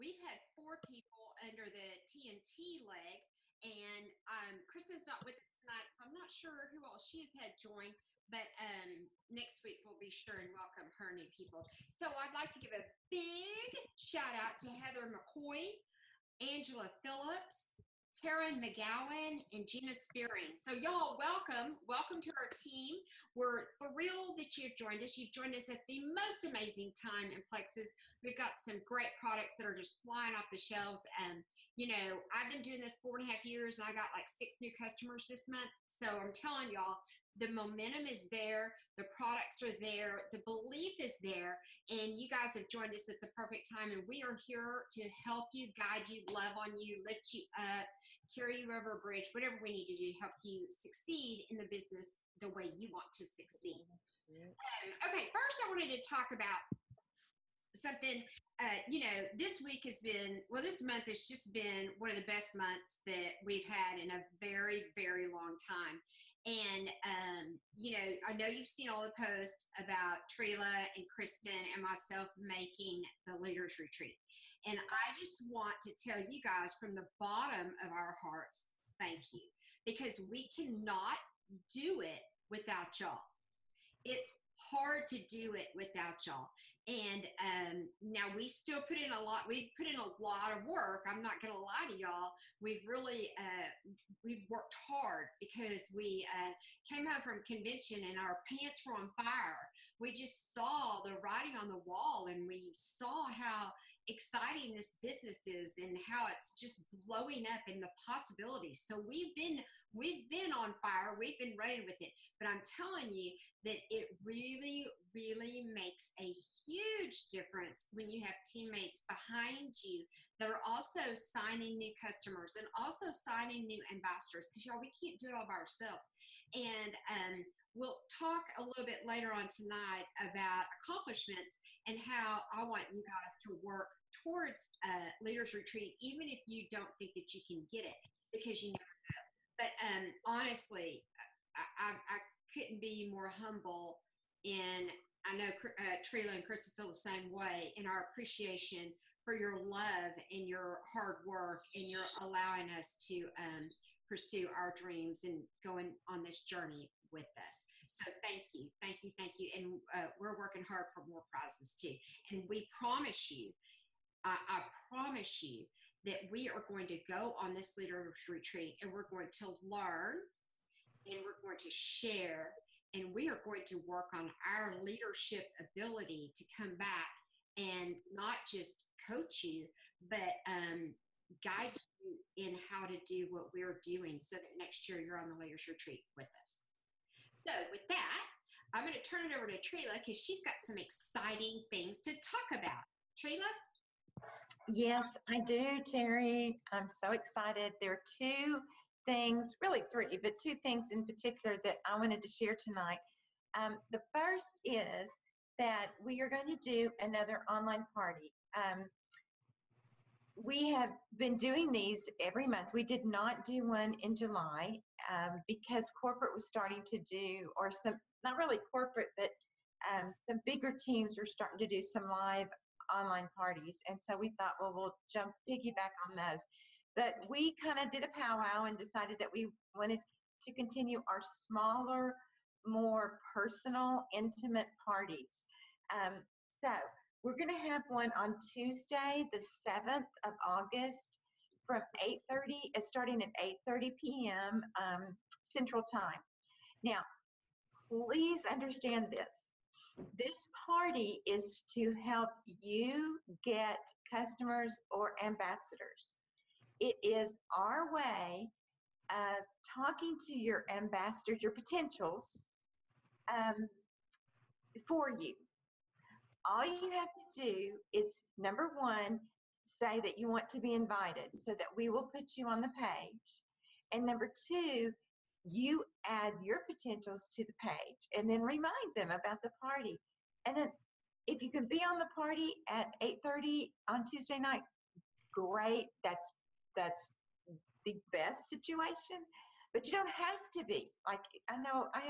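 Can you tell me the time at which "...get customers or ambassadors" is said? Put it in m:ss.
4:13.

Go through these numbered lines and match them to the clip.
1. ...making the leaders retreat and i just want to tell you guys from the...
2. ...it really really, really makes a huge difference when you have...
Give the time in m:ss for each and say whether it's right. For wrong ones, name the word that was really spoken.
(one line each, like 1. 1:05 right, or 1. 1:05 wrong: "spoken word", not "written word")
1. 1:12 right
2. 1:53 right.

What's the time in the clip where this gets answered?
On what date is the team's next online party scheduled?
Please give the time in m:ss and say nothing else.
3:58.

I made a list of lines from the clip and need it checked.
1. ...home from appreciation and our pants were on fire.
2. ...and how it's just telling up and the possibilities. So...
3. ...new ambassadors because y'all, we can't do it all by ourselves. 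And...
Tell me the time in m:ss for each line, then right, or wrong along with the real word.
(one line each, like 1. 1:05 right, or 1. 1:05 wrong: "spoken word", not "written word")
1. 1:37 wrong: "convention", not "appreciation"
2. 1:45 wrong: "blowing", not "telling"
3. 2:03 right.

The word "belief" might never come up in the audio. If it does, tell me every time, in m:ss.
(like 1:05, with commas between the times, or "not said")
0:40.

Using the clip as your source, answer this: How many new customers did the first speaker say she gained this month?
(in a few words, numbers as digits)
6.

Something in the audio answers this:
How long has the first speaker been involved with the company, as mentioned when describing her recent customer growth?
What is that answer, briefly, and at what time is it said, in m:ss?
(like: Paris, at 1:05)
4 and a half years, at 0:32.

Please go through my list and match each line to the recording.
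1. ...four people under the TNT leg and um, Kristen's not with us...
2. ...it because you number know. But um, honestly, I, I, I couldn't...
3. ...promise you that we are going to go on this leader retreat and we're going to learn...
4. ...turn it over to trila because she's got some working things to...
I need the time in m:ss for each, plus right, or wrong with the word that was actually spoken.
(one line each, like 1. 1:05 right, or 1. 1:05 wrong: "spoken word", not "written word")
1. 0:00 right
2. 2:17 wrong: "never", not "number"
3. 2:44 right
4. 3:09 wrong: "exciting", not "working".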